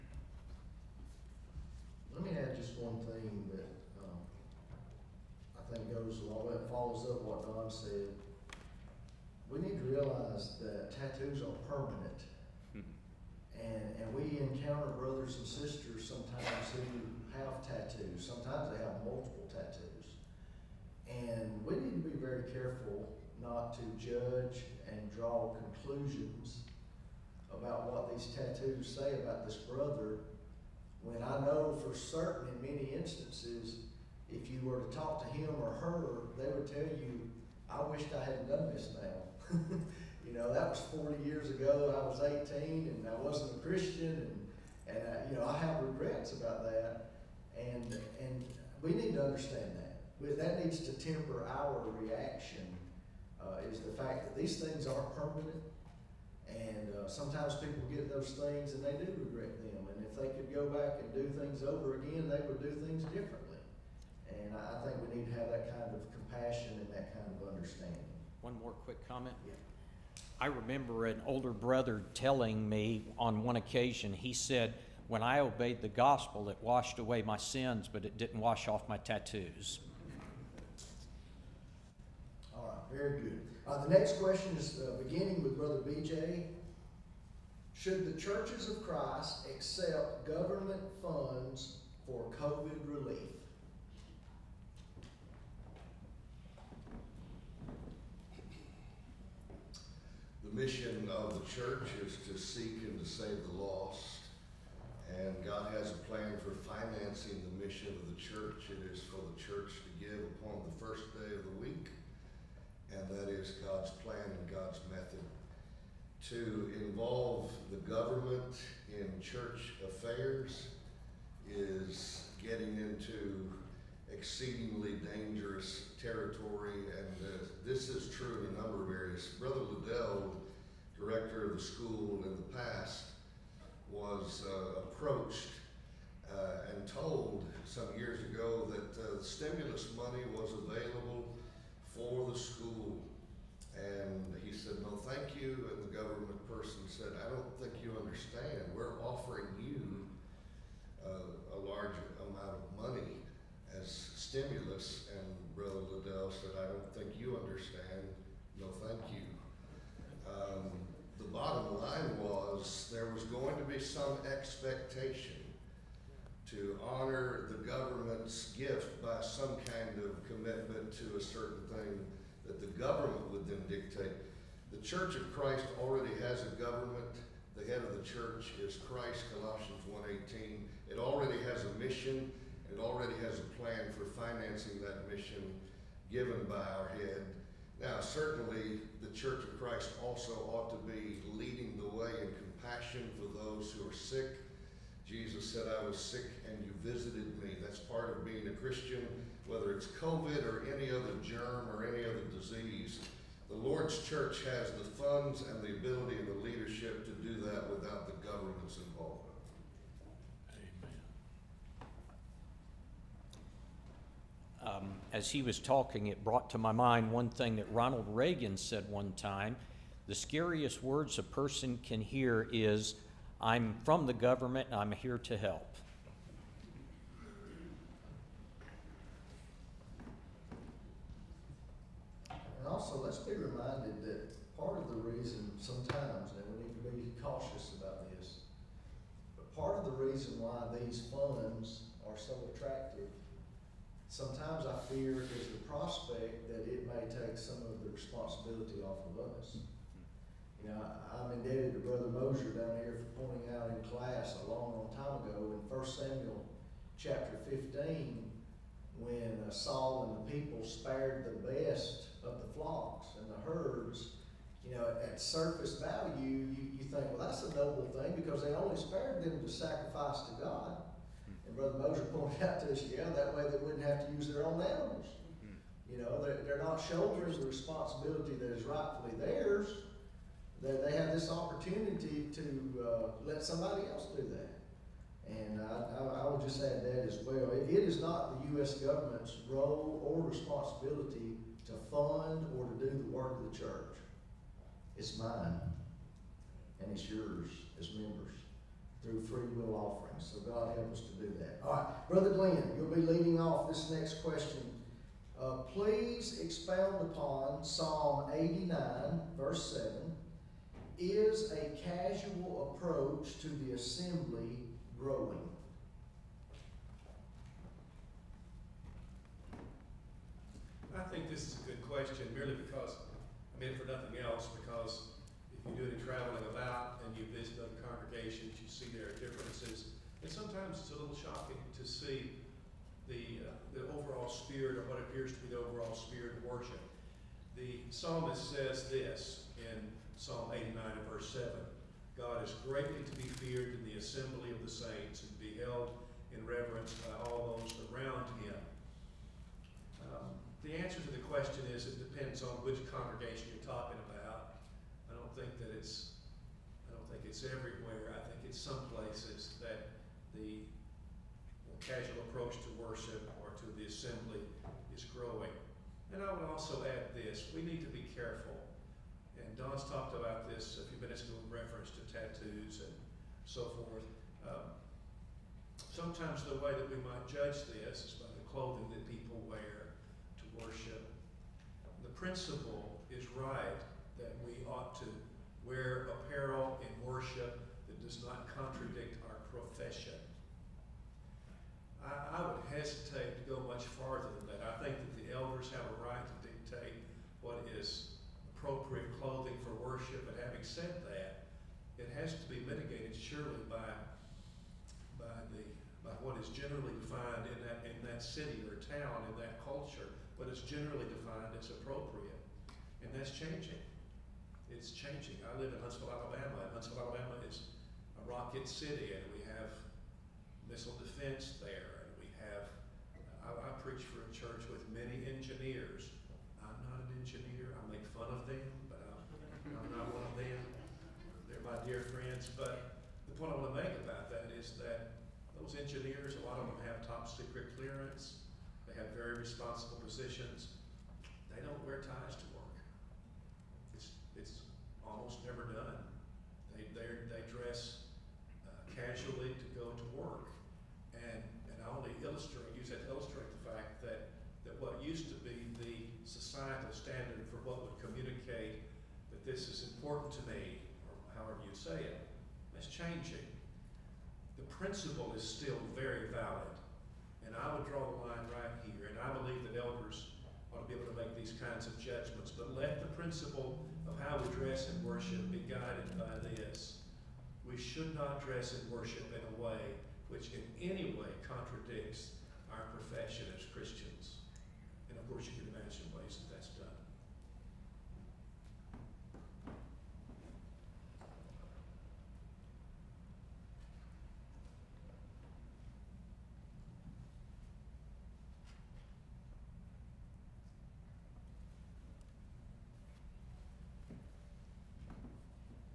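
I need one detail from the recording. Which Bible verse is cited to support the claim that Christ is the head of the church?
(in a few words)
Colossians 1:18.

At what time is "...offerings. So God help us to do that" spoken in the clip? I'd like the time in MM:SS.
04:59.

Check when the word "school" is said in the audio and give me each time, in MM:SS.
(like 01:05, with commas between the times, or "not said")
02:11, 02:22.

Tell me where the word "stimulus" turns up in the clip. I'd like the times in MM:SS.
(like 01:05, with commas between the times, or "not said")
02:19, 02:34.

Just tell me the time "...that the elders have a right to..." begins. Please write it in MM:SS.
06:34.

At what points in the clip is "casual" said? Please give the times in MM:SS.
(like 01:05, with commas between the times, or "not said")
05:11, 06:01.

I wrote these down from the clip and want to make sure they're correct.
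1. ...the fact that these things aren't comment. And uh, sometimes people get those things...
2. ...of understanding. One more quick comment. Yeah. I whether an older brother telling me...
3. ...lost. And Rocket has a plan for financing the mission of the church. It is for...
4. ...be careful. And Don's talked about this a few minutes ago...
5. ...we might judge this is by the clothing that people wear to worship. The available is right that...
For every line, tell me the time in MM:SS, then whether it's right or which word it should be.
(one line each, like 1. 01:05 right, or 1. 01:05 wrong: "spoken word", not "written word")
1. 00:53 wrong: "permanent", not "comment"
2. 01:07 wrong: "remember", not "whether"
3. 01:43 wrong: "God", not "Rocket"
4. 06:07 right
5. 06:16 wrong: "principle", not "available".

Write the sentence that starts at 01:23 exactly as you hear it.
Uh, the next question is uh, beginning with Brother BJ.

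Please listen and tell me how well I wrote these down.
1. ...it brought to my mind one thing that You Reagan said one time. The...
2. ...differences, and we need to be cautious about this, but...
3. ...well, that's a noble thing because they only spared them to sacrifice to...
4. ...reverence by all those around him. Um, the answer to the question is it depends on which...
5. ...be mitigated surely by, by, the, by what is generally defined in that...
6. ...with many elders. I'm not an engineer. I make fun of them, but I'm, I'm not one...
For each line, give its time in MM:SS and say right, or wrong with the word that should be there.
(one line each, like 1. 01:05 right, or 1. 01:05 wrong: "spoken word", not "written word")
1. 03:36 wrong: "Ronald", not "You"
2. 03:55 wrong: "sometimes", not "differences"
3. 04:27 right
4. 05:46 right
5. 06:42 right
6. 07:04 wrong: "engineers", not "elders".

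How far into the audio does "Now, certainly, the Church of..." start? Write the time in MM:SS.
03:07.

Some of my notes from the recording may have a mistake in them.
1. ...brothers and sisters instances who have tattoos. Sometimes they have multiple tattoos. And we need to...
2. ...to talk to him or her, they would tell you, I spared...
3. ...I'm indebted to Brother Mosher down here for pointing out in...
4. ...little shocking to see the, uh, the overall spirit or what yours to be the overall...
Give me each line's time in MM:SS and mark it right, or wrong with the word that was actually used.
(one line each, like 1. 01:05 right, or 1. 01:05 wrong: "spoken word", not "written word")
1. 00:14 wrong: "sometimes", not "instances"
2. 00:34 wrong: "wished", not "spared"
3. 04:11 right
4. 05:30 wrong: "appears", not "yours".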